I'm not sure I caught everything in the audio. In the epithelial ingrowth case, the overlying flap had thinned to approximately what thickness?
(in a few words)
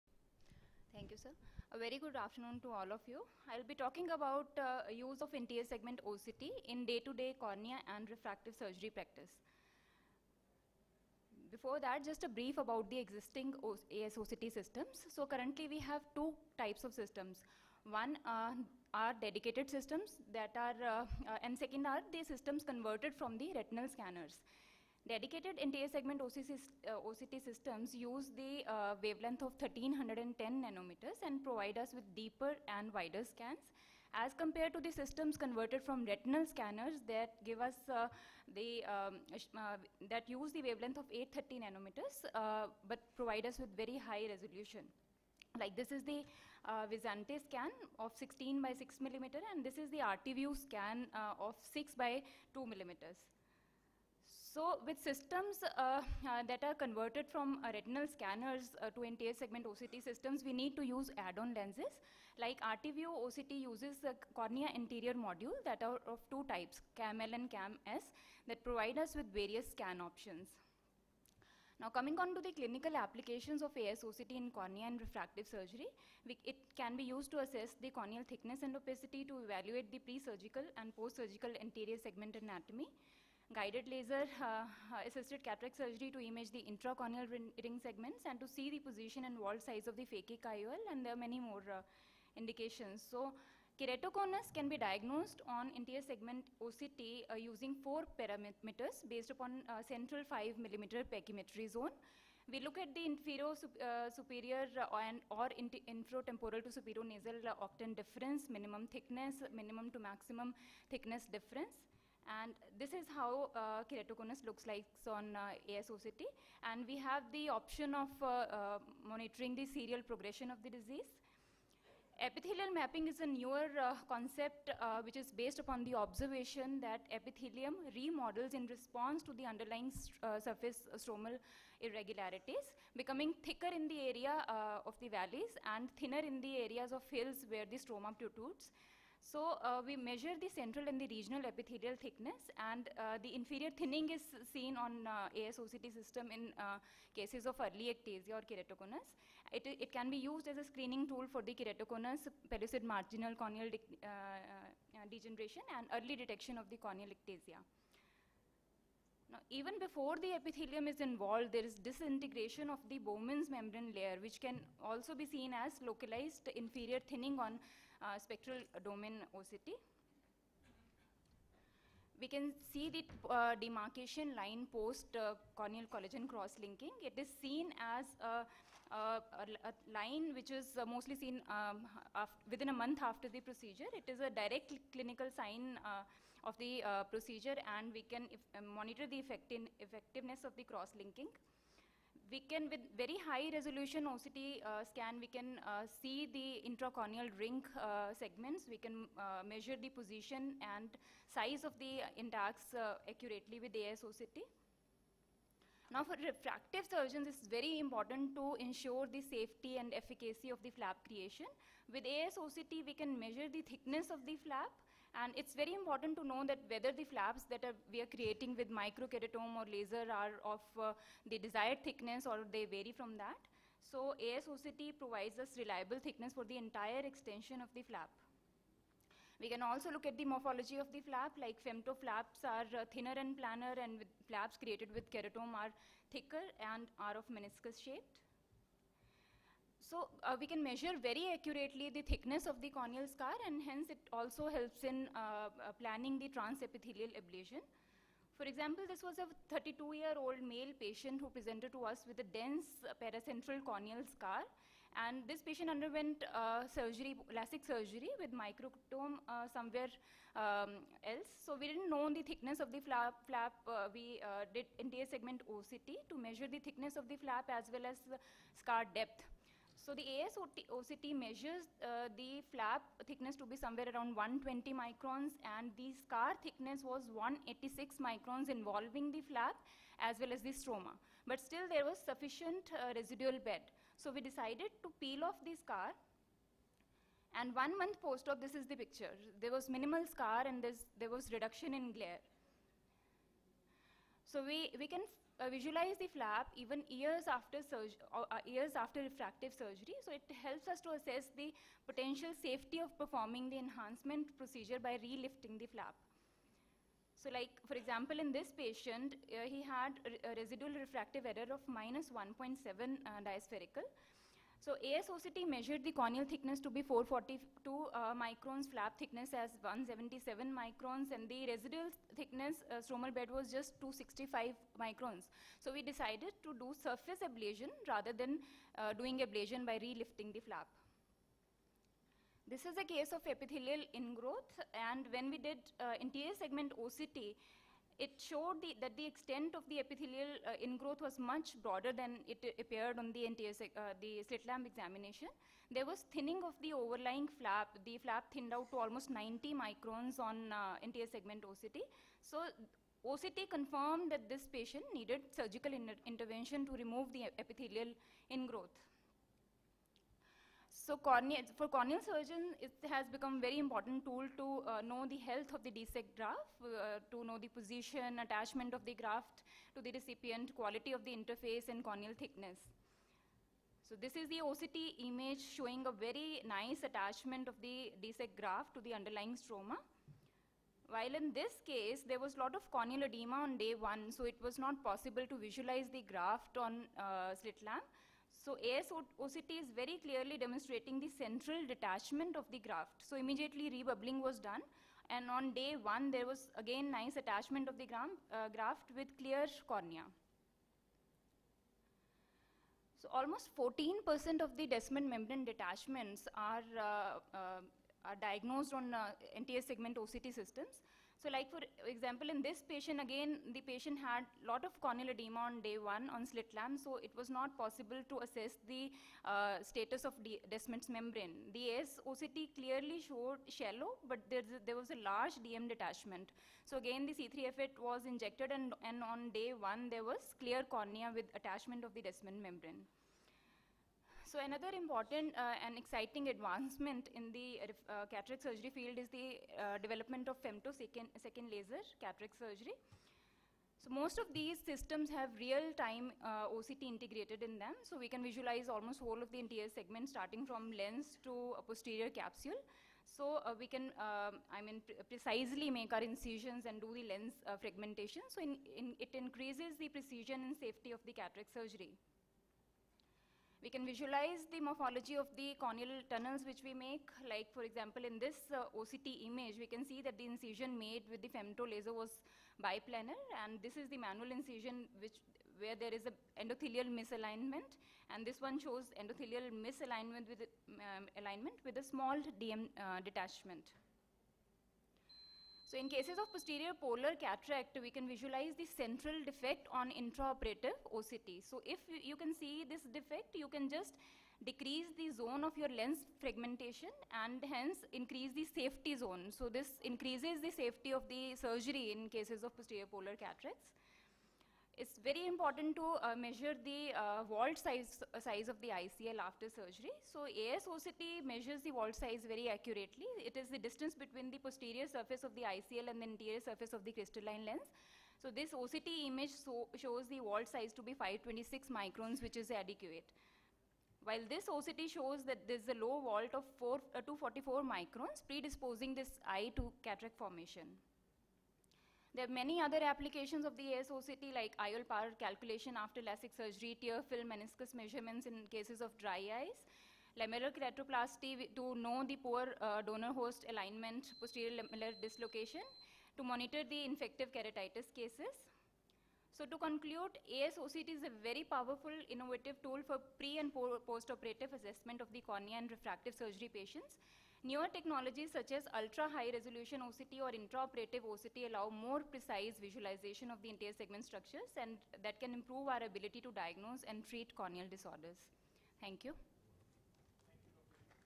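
90 microns.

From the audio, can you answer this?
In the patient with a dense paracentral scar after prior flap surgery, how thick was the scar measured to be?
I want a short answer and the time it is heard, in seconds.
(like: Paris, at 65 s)
186 microns, at 277 s.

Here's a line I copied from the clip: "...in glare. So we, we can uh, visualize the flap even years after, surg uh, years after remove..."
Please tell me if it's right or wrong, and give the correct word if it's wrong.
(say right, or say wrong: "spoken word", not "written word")
wrong: "refractive", not "remove".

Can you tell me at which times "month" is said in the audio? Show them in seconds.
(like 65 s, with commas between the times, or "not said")
182 s, 287 s.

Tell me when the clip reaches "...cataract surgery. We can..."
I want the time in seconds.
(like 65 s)
461 s.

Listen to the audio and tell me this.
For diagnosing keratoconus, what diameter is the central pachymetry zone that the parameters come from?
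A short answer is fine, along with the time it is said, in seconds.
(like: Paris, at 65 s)
5 millimeter, at 100 s.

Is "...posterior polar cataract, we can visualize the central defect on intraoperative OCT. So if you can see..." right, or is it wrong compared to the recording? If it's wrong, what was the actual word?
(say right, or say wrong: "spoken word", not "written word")
right.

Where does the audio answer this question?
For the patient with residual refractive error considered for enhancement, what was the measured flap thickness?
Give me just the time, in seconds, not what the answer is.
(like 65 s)
319 s.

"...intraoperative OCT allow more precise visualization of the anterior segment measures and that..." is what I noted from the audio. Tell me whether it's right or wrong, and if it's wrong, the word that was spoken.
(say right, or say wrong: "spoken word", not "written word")
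wrong: "structures", not "measures".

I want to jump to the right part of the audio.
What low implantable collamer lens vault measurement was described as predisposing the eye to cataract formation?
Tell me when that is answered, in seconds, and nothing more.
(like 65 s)
527 s.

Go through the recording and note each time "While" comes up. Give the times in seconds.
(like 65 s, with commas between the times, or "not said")
380 s, 524 s.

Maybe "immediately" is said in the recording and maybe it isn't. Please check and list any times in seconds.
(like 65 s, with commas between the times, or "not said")
393 s.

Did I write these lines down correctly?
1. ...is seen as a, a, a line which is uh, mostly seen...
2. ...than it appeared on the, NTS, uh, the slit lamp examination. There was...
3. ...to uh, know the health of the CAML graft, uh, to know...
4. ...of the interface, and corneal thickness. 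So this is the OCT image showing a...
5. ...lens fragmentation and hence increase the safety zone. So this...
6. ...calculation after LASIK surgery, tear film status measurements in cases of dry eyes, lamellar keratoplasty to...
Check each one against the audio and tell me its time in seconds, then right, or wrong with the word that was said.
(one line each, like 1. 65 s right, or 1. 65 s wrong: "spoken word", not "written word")
1. 177 s right
2. 341 s right
3. 364 s wrong: "DSEK", not "CAML"
4. 370 s right
5. 495 s right
6. 535 s wrong: "meniscus", not "status".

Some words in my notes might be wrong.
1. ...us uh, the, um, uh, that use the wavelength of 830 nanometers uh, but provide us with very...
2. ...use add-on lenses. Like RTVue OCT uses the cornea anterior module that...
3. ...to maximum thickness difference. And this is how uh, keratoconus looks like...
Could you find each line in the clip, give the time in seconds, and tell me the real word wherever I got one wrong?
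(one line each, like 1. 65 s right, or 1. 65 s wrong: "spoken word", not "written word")
1. 37 s right
2. 60 s right
3. 109 s right.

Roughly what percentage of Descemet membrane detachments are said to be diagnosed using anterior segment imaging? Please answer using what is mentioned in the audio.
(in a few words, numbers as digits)
14%.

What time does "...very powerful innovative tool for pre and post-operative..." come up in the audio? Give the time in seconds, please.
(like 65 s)
551 s.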